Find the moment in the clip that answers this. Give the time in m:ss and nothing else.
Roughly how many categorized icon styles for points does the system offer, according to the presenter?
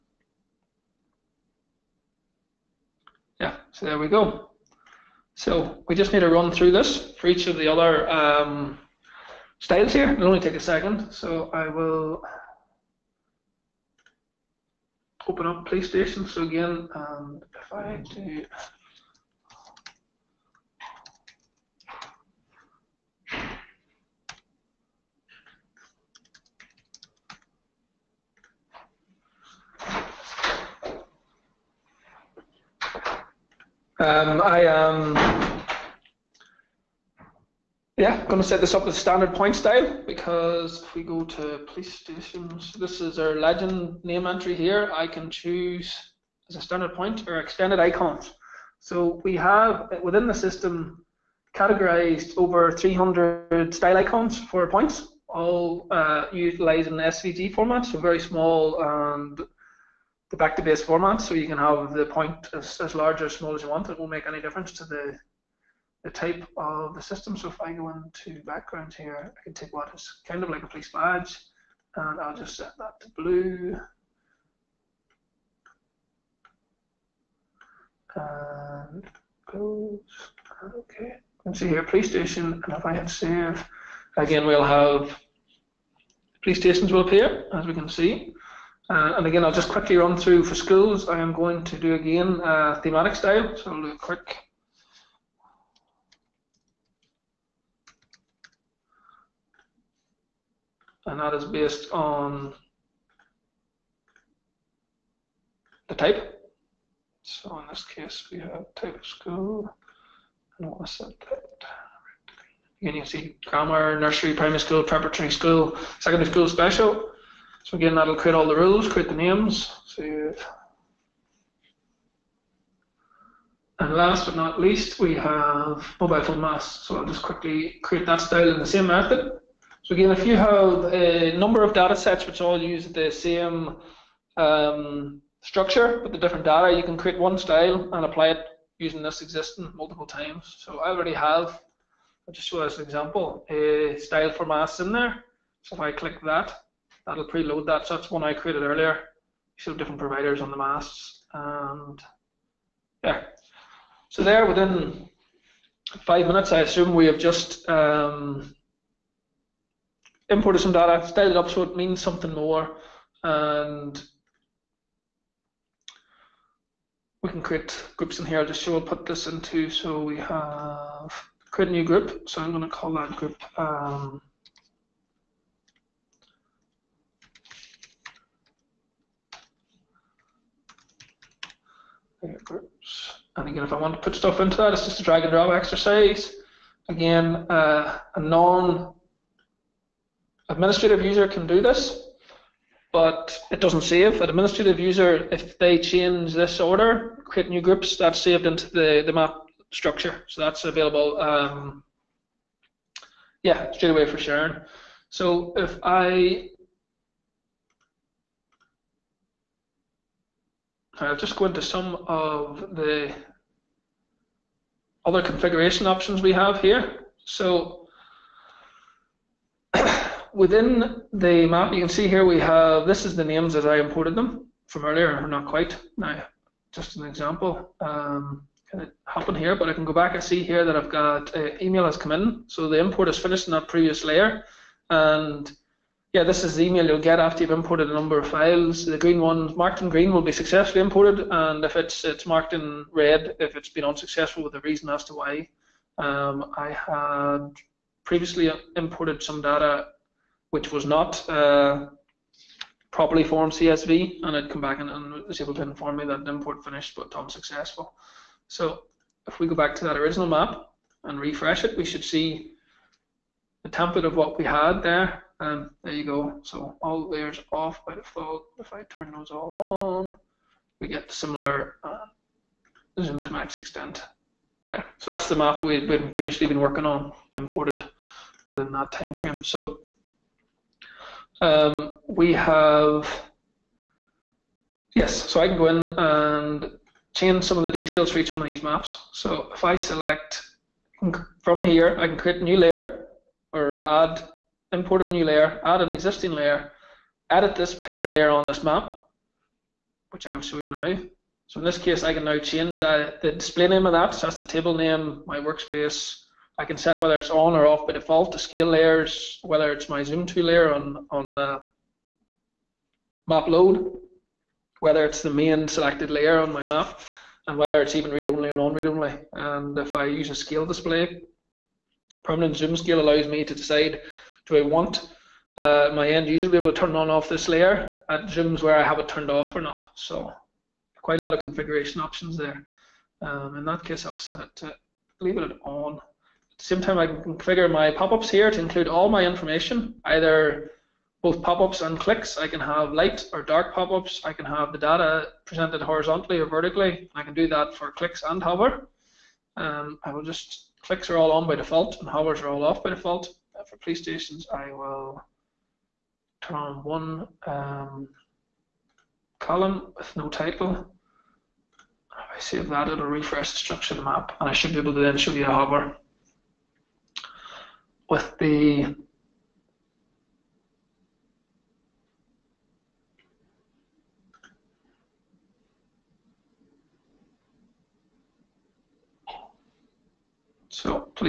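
0:52.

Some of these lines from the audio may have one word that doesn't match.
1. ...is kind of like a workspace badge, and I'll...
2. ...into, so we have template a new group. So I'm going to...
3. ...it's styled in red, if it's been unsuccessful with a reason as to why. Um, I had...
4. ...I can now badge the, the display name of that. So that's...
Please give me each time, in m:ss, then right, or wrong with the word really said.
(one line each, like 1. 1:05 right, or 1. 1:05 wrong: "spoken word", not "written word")
1. 1:09 wrong: "police", not "workspace"
2. 2:49 wrong: "create", not "template"
3. 4:02 wrong: "marked", not "styled"
4. 5:02 wrong: "change", not "badge".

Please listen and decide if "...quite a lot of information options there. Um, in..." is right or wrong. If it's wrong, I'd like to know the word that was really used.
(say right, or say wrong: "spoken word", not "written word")
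wrong: "configuration", not "information".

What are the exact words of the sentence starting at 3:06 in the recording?
Again, uh, a non administrative user can do this, but it doesn't save.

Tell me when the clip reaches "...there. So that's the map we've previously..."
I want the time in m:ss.
4:34.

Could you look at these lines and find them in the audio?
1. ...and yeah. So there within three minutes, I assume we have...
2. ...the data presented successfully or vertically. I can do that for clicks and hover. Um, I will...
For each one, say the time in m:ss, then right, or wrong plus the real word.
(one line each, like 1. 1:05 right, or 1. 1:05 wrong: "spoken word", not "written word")
1. 2:31 wrong: "five", not "three"
2. 5:44 wrong: "horizontally", not "successfully".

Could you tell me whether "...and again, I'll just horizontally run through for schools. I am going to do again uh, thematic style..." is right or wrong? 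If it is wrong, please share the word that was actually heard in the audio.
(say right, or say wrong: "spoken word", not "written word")
wrong: "quickly", not "horizontally".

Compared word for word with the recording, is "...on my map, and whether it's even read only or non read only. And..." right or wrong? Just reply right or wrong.
right.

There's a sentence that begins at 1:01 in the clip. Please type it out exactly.
So you can have the point as, as large or small as you want.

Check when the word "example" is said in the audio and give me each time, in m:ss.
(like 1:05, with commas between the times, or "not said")
2:22, 3:47.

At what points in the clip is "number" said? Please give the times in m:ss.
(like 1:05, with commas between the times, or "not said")
2:11, 3:57.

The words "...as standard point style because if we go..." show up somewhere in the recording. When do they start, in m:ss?
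0:38.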